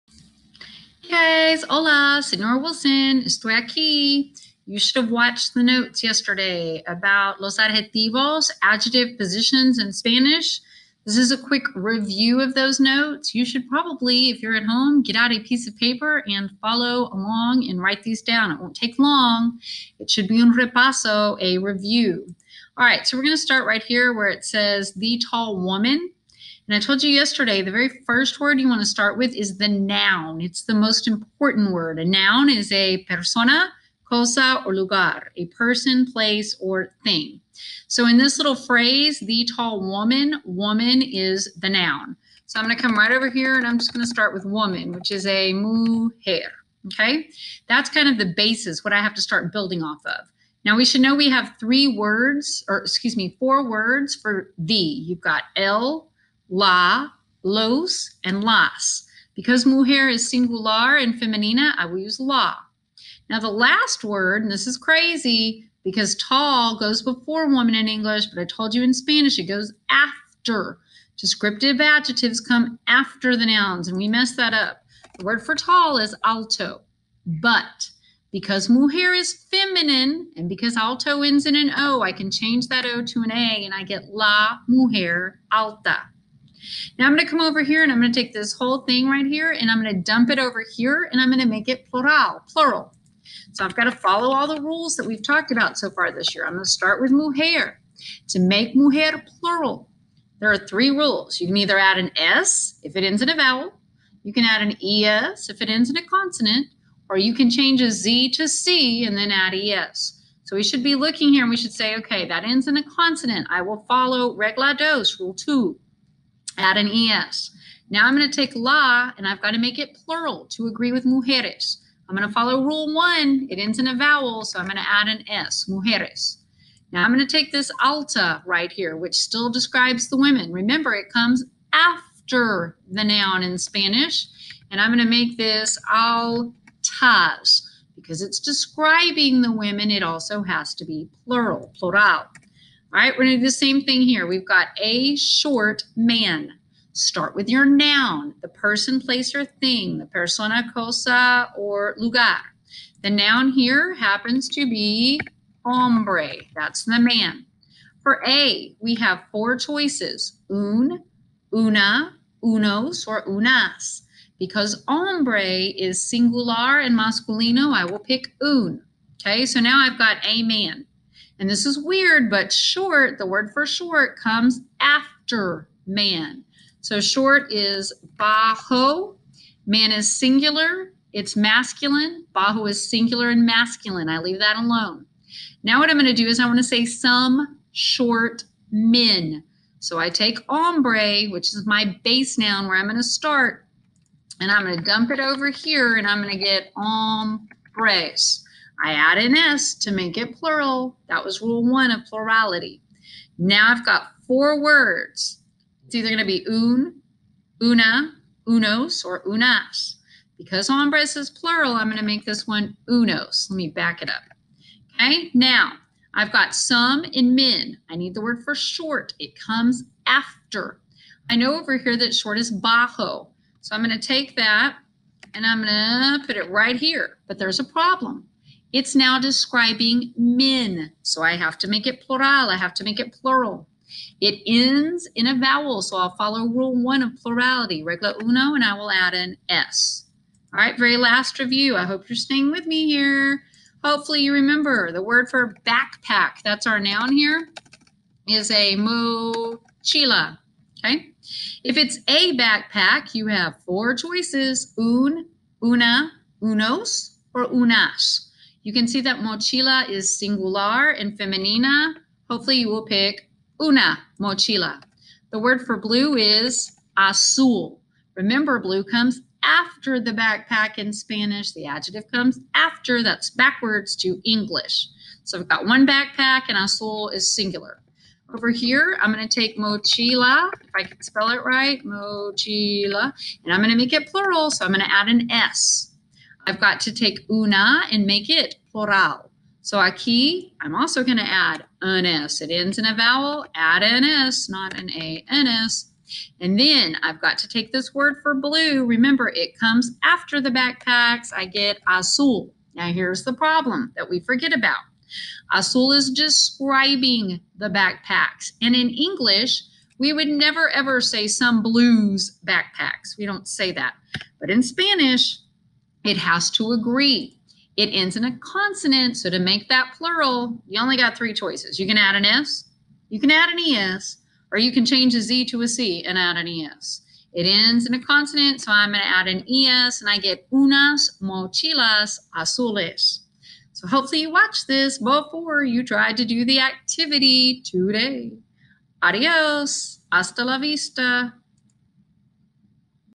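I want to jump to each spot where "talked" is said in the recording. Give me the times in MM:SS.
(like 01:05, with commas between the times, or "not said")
01:35.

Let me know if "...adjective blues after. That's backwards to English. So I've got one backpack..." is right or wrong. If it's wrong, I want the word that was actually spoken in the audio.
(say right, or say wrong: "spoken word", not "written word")
wrong: "comes", not "blues".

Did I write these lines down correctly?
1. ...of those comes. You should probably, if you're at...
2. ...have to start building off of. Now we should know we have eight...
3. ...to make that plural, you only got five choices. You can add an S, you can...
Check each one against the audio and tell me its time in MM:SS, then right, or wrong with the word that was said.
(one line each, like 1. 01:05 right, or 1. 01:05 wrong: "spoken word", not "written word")
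1. 00:12 wrong: "notes", not "comes"
2. 00:49 wrong: "three", not "eight"
3. 05:19 wrong: "three", not "five".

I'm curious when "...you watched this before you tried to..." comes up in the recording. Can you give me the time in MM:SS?
05:34.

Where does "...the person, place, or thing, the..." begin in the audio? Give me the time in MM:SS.
02:28.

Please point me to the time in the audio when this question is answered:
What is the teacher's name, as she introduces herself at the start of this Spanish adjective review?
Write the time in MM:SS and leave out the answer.
00:02.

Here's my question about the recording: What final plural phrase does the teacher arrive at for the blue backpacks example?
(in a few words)
unas mochilas azules.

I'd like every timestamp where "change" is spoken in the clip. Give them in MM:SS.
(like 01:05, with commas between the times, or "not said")
01:22, 01:47, 05:24.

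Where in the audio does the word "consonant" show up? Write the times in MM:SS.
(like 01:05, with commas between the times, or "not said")
01:46, 01:52, 05:18, 05:28.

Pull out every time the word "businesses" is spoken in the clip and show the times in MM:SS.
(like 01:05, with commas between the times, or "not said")
not said.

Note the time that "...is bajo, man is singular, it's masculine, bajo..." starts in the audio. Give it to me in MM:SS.
02:57.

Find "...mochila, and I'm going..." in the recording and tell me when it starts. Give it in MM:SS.
04:41.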